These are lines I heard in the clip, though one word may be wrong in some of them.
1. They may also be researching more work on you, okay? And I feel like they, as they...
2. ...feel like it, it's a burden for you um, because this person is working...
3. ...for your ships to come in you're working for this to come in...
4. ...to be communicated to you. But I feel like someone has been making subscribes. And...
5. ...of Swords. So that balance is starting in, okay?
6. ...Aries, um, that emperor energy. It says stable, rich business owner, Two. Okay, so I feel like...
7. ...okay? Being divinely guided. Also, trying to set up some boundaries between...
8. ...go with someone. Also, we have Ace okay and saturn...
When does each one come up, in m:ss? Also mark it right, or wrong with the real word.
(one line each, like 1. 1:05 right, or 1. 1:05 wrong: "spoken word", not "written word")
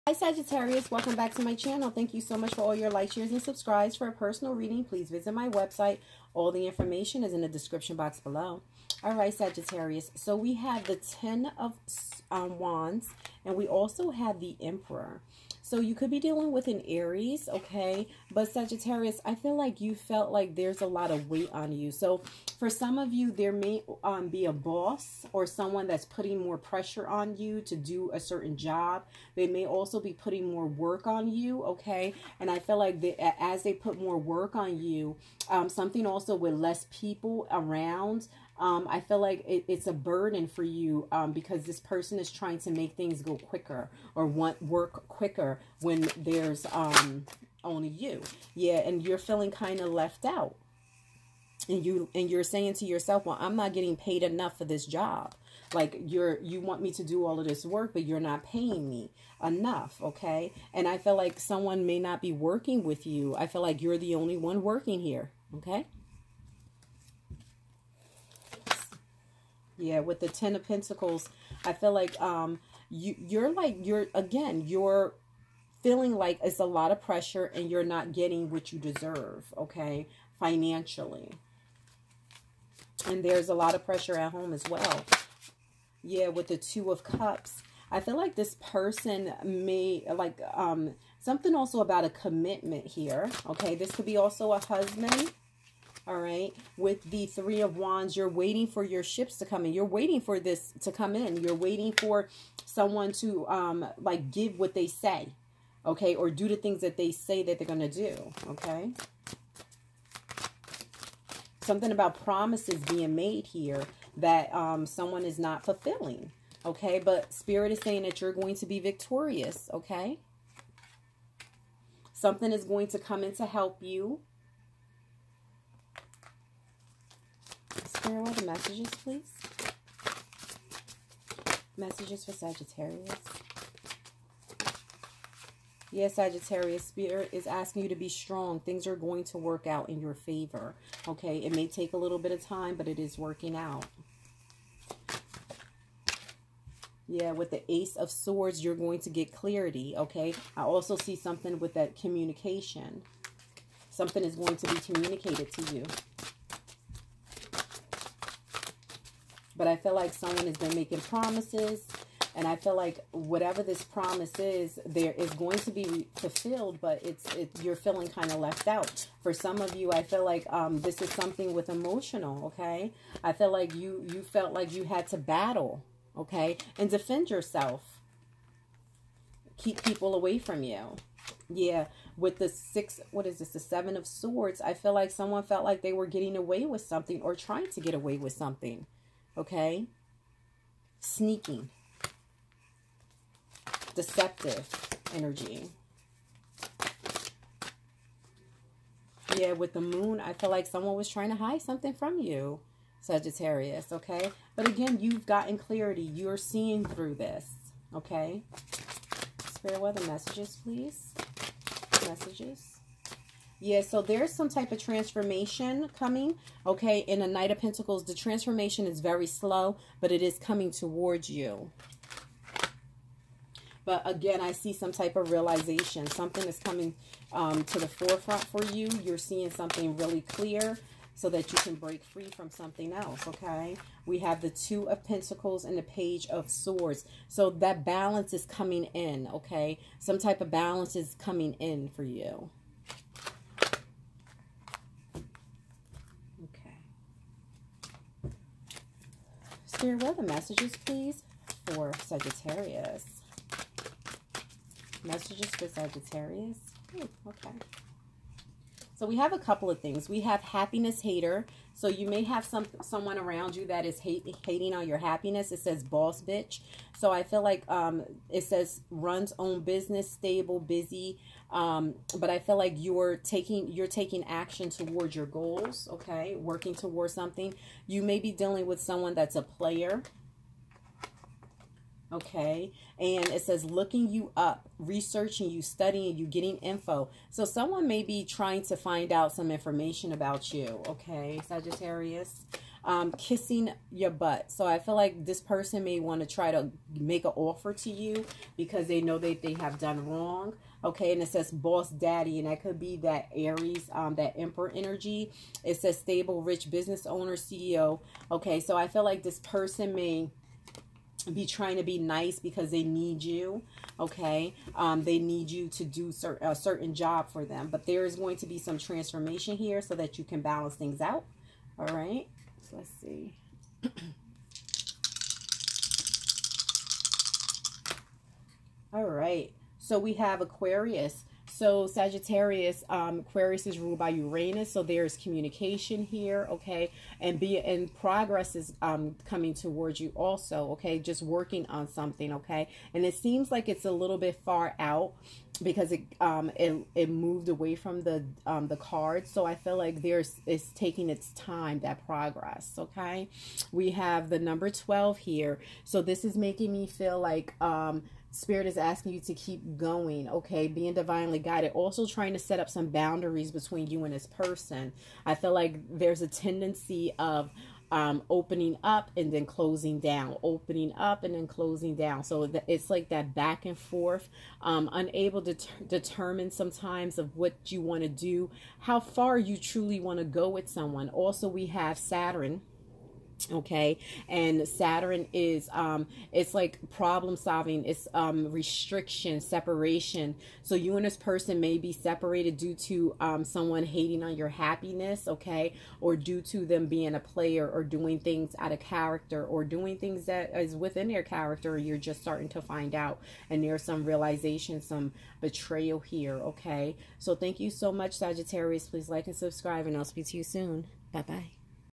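1. 0:29 wrong: "putting", not "researching"
2. 0:38 wrong: "trying", not "working"
3. 1:38 wrong: "waiting", not "working"
4. 2:34 wrong: "promises", not "subscribes"
5. 3:56 wrong: "coming", not "starting"
6. 5:03 wrong: "CEO", not "Two"
7. 6:00 right
8. 6:20 wrong: "Saturn", not "Ace".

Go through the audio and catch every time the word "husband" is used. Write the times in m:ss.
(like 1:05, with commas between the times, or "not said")
1:34.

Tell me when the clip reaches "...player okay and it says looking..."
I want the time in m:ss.
4:39.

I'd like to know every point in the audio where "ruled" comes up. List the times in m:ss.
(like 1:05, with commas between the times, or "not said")
5:33.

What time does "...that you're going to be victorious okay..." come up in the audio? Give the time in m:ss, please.
1:58.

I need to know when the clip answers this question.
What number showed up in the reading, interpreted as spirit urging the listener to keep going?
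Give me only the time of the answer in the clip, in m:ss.
5:54.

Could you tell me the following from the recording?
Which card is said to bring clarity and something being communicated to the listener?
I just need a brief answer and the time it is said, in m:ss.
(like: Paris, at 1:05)
Ace of Swords, at 2:27.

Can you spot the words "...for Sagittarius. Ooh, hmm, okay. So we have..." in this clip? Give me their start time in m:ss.
4:15.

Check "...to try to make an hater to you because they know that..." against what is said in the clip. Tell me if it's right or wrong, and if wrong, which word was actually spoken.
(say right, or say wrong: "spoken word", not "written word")
wrong: "offer", not "hater".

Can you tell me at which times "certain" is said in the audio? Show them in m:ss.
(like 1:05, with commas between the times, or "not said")
0:28, 5:16.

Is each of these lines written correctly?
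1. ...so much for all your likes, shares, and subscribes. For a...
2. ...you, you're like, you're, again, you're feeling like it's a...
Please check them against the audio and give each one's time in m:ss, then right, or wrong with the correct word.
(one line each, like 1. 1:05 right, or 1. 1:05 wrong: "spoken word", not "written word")
1. 0:02 right
2. 1:12 right.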